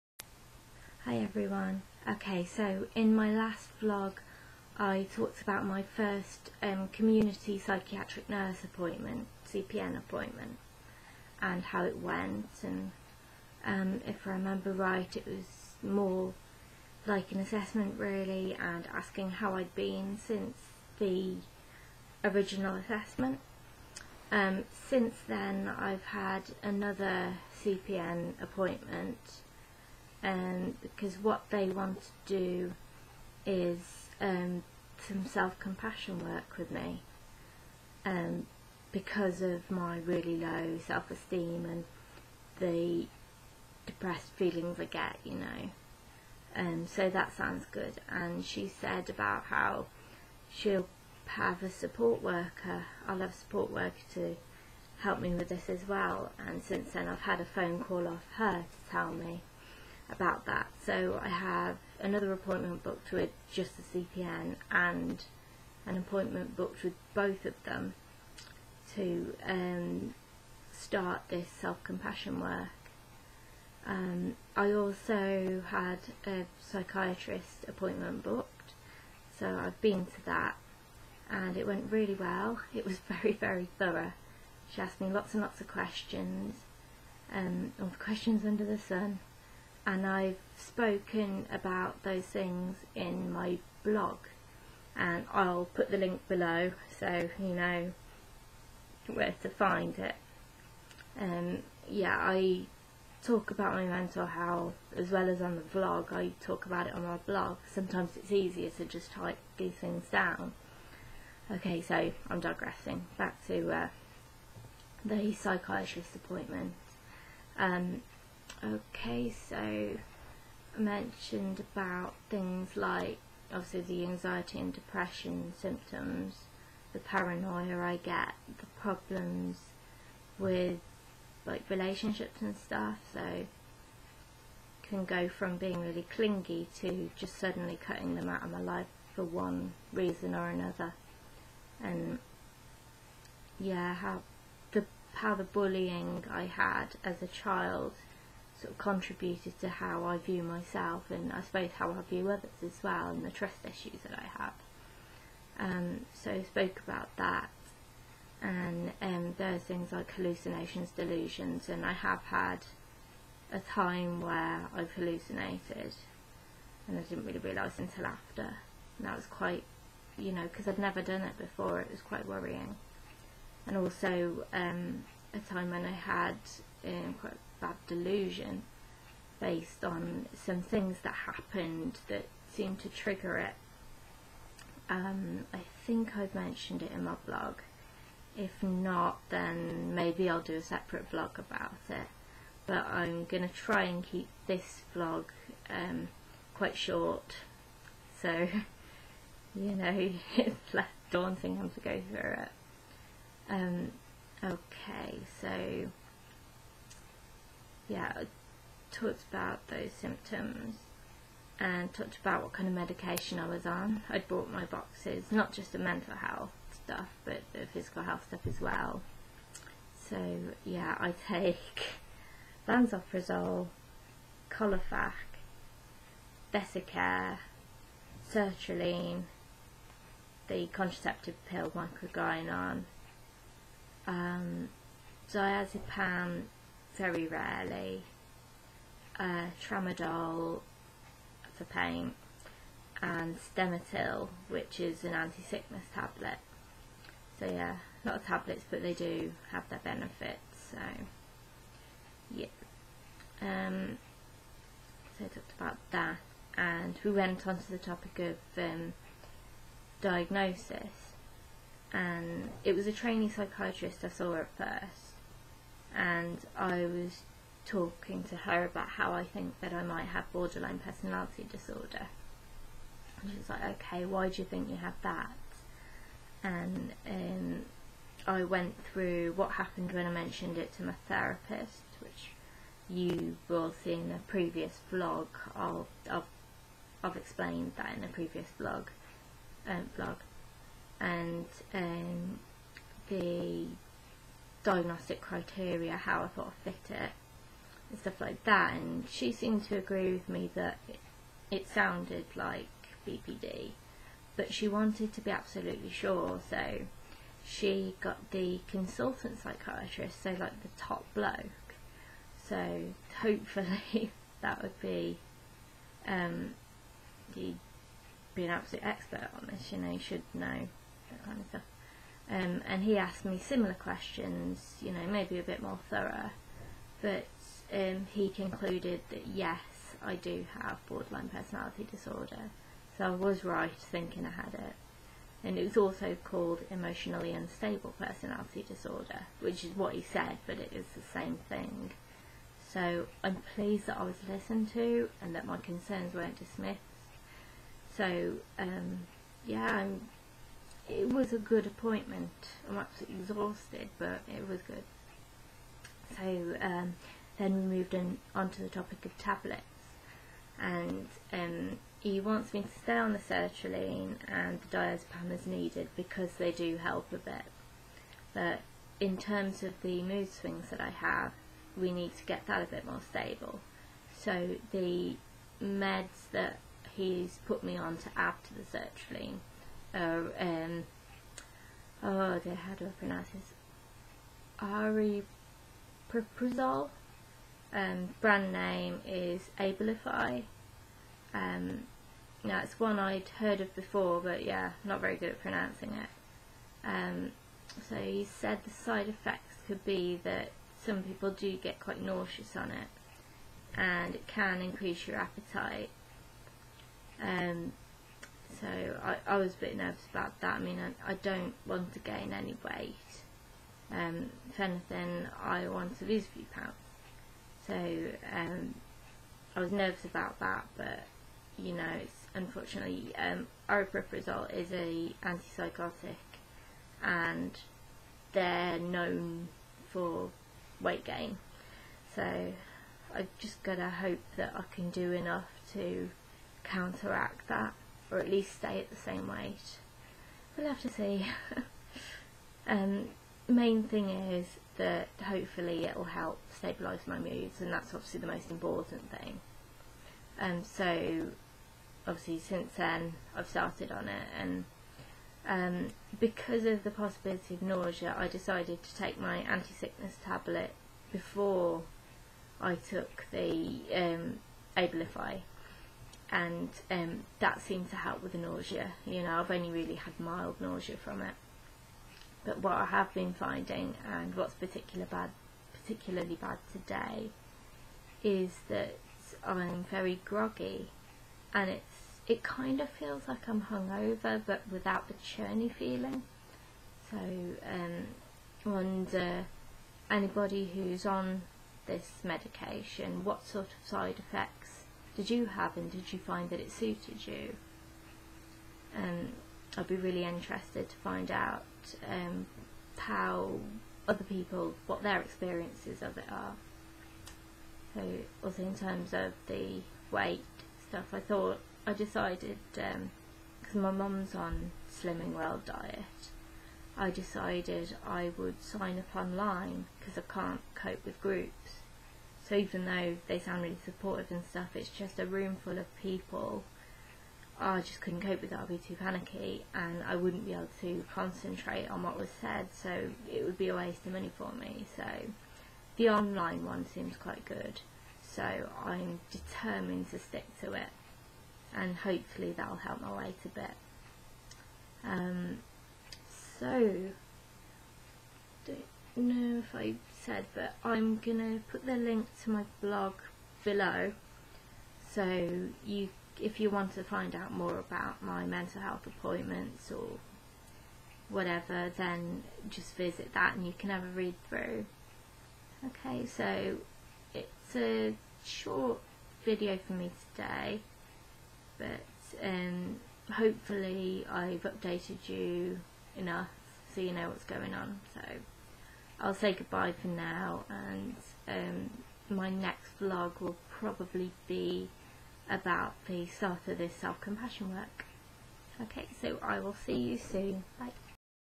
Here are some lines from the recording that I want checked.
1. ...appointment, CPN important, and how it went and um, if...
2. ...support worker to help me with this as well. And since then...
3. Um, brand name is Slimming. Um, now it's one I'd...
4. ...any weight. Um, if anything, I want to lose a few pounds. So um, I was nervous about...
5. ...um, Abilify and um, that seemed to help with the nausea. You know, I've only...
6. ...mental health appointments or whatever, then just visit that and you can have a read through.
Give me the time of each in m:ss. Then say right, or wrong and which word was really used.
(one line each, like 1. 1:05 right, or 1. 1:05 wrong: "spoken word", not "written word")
1. 0:08 wrong: "appointment", not "important"
2. 0:53 right
3. 6:27 wrong: "Abilify", not "Slimming"
4. 6:52 right
5. 7:43 right
6. 9:18 right.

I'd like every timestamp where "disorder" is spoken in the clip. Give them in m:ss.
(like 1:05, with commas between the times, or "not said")
4:31, 5:31, 5:38.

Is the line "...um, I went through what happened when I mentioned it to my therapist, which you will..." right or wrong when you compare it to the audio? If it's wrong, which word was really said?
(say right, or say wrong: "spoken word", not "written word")
right.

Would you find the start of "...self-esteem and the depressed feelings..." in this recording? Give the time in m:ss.
0:40.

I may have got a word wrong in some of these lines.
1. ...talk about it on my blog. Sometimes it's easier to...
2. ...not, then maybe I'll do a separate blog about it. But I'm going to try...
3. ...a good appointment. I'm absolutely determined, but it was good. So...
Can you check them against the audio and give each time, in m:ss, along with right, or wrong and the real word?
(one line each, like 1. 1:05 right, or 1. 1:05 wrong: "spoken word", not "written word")
1. 1:46 right
2. 3:08 right
3. 5:51 wrong: "exhausted", not "determined".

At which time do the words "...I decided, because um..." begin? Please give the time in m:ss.
8:31.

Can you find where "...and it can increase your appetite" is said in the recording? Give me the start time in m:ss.
6:43.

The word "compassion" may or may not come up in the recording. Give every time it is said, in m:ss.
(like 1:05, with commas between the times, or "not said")
0:35, 1:11, 9:46.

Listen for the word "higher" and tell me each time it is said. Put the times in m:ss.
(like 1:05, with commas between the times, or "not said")
not said.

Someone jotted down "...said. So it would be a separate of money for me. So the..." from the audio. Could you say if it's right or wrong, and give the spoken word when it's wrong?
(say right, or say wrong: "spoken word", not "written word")
wrong: "waste", not "separate".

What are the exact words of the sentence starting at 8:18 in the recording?
Um, I'd be really interested to find out um, how other people, what their experiences of it are.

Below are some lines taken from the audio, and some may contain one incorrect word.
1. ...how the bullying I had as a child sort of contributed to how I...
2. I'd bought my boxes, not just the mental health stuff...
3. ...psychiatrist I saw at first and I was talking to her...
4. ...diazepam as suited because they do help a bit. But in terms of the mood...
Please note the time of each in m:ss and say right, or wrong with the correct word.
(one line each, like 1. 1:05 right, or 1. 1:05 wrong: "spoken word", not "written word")
1. 2:25 right
2. 3:34 right
3. 4:23 right
4. 6:04 wrong: "needed", not "suited".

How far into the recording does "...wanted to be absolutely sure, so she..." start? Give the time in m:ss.
5:04.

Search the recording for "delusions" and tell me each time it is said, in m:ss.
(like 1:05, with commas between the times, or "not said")
2:40, 2:57.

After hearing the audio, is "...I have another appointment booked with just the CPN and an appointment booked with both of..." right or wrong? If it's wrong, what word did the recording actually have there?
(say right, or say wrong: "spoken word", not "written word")
right.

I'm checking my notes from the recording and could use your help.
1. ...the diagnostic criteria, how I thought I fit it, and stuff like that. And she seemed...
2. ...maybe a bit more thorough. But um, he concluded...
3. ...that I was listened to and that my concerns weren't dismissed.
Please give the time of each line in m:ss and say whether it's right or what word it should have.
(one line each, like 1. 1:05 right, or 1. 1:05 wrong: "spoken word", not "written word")
1. 4:53 right
2. 5:25 right
3. 5:43 right.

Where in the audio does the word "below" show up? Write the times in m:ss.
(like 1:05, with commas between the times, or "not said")
1:36, 9:13.